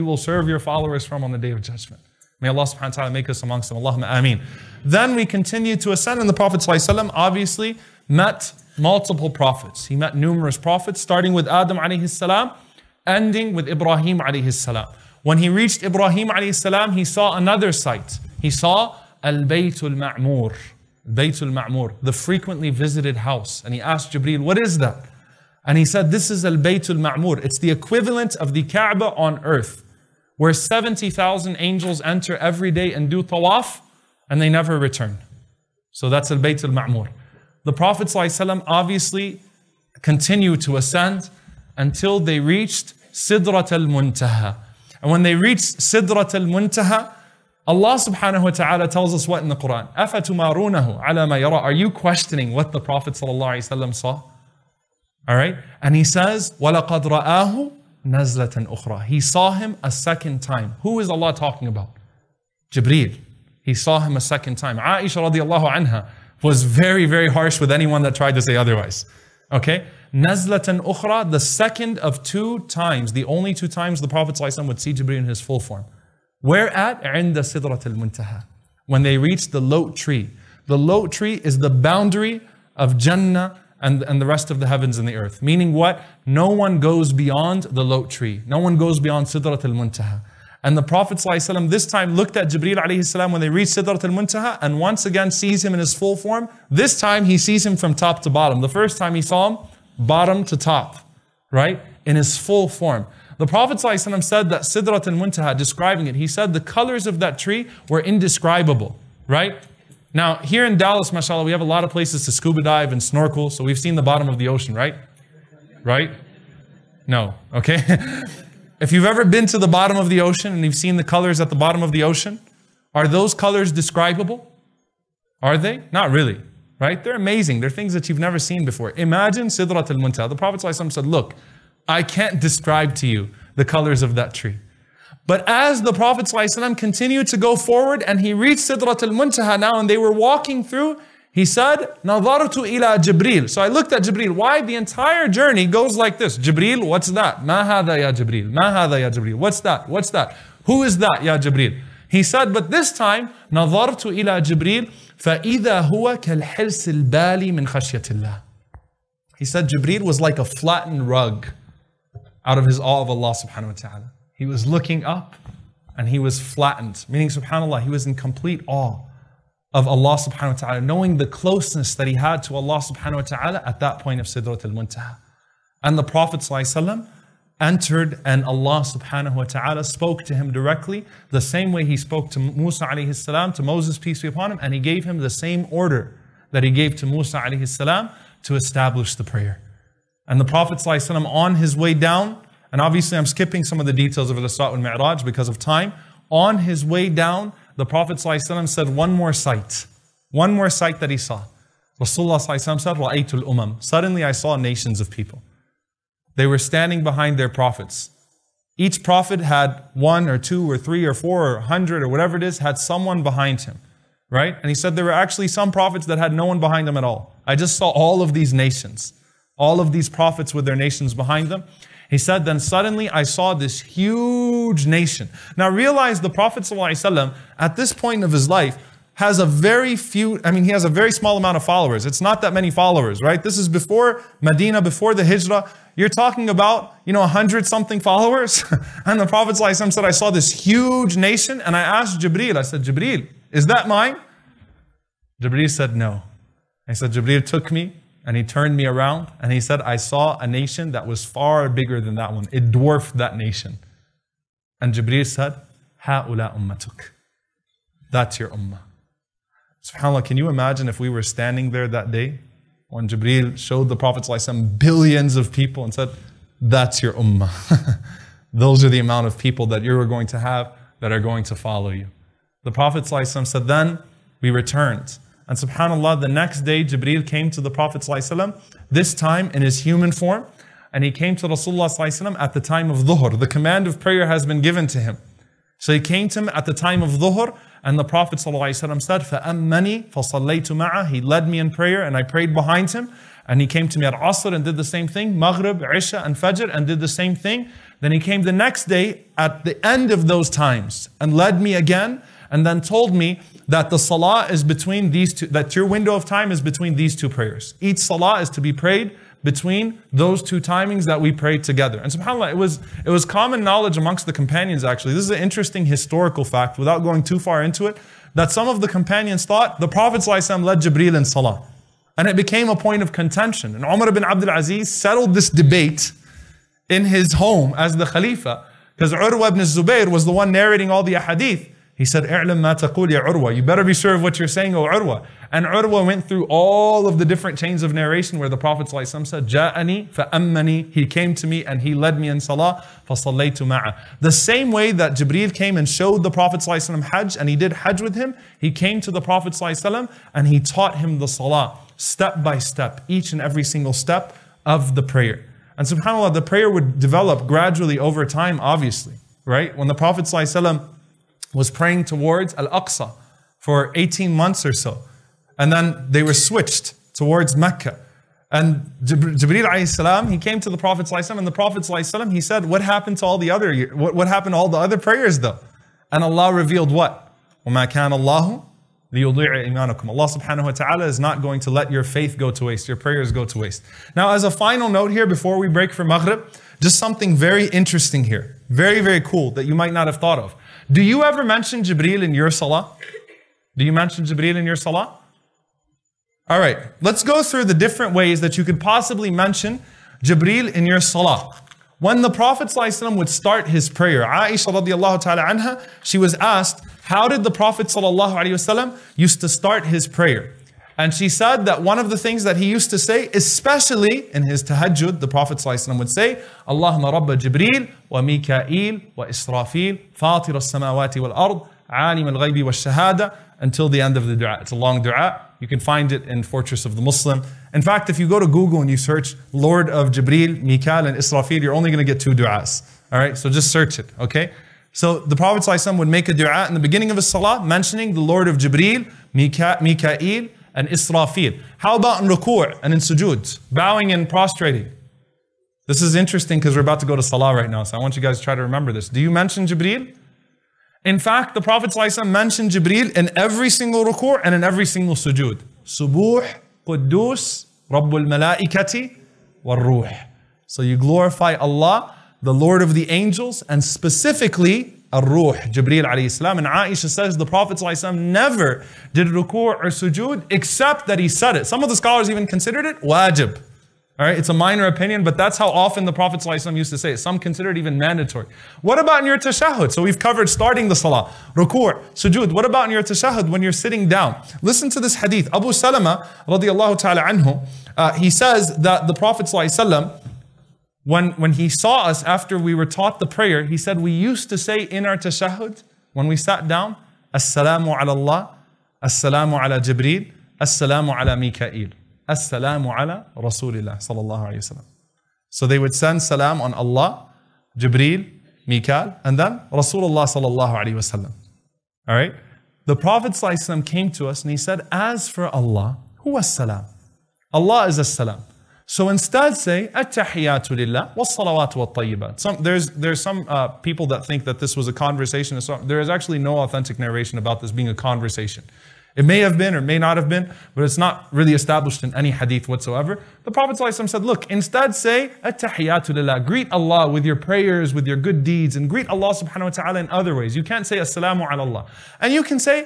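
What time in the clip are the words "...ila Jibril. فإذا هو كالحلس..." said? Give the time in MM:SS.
02:34.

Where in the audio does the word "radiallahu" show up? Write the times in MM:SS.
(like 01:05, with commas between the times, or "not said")
01:05, 06:44, 08:06.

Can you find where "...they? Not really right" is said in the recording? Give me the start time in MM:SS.
02:05.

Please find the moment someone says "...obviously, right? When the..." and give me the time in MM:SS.
05:58.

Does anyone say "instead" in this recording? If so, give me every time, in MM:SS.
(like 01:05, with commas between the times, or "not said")
08:39, 08:54.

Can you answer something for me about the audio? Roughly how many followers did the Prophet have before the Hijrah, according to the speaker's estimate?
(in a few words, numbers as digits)
100 something.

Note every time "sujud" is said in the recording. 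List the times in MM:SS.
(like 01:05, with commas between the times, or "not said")
07:22, 07:35, 07:49, 08:02.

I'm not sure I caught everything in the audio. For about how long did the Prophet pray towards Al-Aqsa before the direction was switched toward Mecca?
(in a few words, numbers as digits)
18 months.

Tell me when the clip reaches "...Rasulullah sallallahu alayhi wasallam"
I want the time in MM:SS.
08:29.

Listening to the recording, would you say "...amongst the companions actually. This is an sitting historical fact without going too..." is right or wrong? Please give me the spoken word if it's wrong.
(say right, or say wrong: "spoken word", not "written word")
wrong: "interesting", not "sitting".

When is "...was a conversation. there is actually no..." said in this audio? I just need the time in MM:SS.
08:44.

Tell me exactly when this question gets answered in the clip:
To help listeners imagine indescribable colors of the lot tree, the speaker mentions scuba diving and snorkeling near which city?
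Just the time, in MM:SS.
01:50.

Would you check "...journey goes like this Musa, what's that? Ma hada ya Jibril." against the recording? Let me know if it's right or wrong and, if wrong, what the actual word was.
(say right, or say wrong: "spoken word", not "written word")
wrong: "Jibril", not "Musa".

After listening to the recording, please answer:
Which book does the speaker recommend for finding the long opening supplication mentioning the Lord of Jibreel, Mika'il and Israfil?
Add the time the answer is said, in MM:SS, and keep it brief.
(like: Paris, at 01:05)
Fortress of the Muslim, at 07:06.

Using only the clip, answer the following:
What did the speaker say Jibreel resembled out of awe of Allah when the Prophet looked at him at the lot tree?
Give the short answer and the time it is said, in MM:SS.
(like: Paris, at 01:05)
a flattened rug, at 02:40.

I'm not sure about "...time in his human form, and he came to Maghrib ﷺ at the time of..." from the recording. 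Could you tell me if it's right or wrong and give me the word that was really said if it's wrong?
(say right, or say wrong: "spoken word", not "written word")
wrong: "Rasulullah", not "Maghrib".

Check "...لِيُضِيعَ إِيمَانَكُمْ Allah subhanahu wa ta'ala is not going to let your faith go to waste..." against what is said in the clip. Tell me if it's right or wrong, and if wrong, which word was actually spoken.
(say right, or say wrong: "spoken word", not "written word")
right.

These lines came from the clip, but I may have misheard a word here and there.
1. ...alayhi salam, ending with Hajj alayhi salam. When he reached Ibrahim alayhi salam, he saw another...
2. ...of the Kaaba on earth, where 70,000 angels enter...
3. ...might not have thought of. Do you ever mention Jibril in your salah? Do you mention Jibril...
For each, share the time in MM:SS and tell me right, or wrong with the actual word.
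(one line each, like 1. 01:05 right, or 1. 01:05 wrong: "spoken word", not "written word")
1. 00:11 wrong: "Ibrahim", not "Hajj"
2. 00:28 right
3. 06:29 right.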